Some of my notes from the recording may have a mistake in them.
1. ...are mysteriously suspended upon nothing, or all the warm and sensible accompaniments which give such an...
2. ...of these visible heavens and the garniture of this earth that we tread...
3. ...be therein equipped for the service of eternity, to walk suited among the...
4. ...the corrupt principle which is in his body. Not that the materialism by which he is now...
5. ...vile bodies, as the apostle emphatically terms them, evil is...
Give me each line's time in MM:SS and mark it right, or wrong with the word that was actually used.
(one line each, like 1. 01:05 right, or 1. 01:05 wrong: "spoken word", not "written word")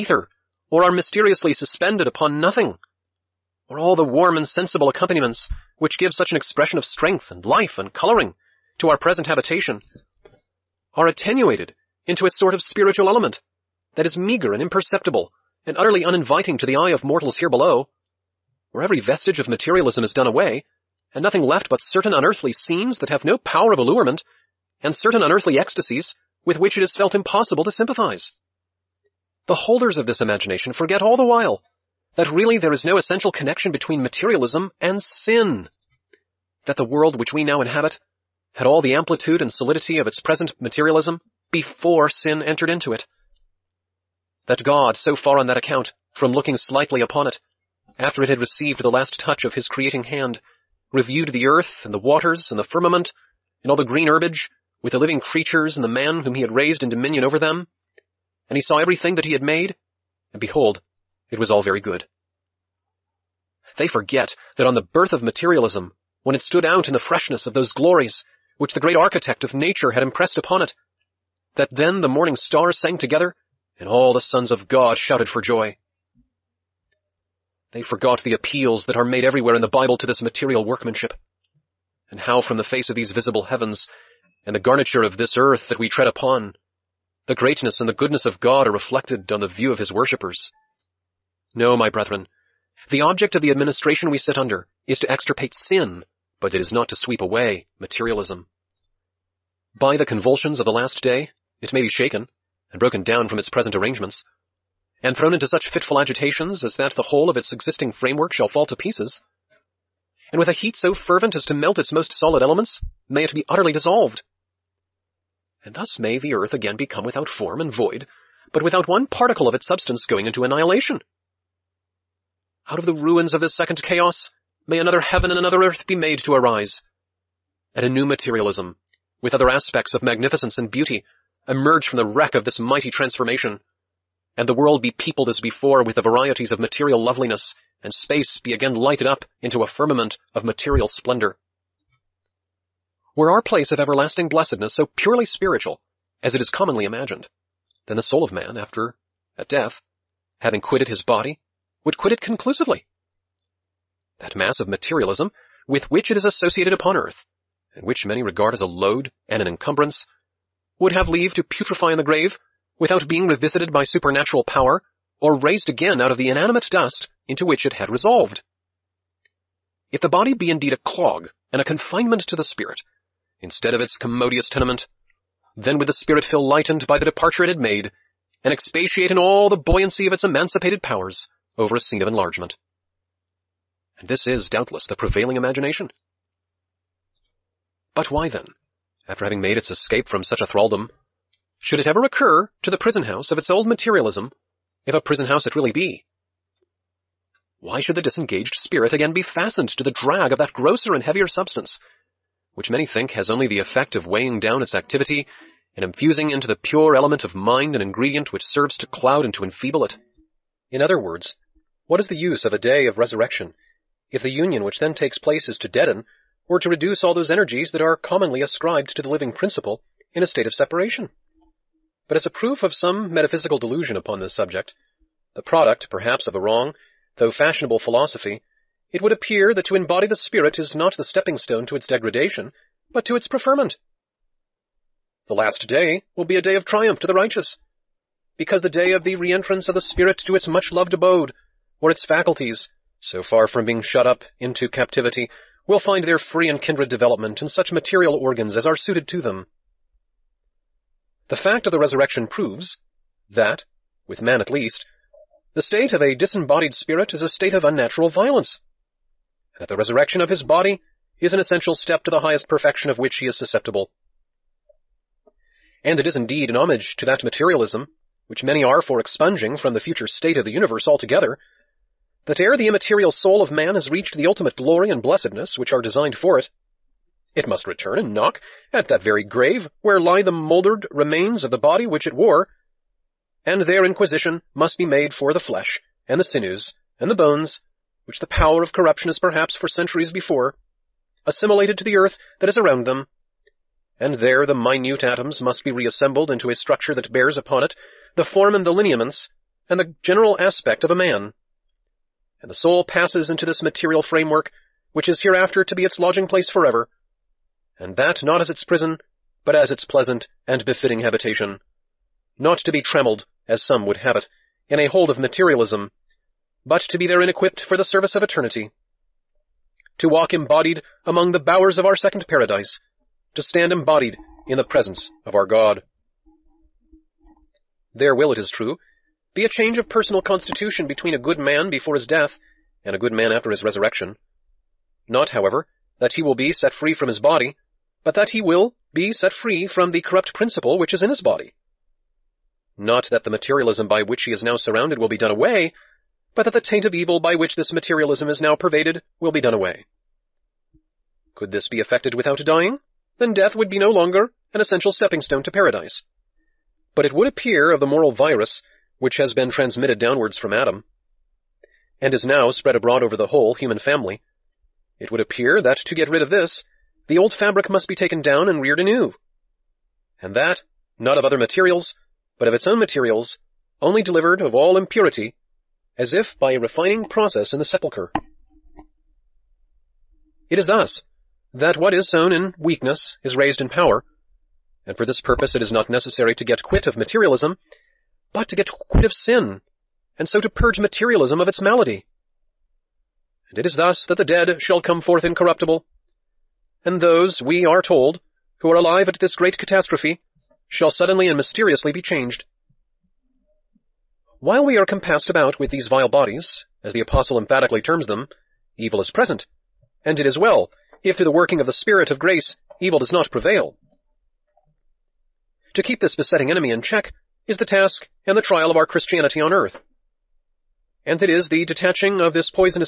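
1. 00:00 right
2. 01:22 right
3. 05:16 wrong: "embodied", not "suited"
4. 05:39 right
5. 06:45 right.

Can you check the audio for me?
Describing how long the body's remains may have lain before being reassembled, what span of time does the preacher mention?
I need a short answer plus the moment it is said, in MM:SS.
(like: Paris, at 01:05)
centuries, at 04:49.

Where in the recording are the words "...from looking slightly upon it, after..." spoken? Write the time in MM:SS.
00:46.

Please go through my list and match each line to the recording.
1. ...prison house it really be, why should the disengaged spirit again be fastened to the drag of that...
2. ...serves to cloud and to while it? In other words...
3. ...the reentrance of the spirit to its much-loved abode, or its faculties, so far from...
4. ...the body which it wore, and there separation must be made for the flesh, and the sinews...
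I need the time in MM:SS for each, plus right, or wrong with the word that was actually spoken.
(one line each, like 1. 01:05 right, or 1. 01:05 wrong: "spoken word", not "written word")
1. 03:15 right
2. 03:28 wrong: "enfeeble", not "while"
3. 03:59 right
4. 04:41 wrong: "inquisition", not "separation".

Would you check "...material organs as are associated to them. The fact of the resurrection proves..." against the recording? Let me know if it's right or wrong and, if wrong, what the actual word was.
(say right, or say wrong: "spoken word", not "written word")
wrong: "suited", not "associated".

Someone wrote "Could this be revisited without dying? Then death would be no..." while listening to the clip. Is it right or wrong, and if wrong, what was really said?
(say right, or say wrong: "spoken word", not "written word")
wrong: "effected", not "revisited".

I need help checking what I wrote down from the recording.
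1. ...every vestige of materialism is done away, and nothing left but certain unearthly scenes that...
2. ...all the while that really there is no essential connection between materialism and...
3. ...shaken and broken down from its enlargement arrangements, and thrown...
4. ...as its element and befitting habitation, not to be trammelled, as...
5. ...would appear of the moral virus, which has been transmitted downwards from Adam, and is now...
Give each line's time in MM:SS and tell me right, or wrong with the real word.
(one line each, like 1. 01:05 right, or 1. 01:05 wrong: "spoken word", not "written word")
1. 00:18 right
2. 00:31 right
3. 01:41 wrong: "present", not "enlargement"
4. 05:09 wrong: "pleasant", not "element"
5. 05:57 right.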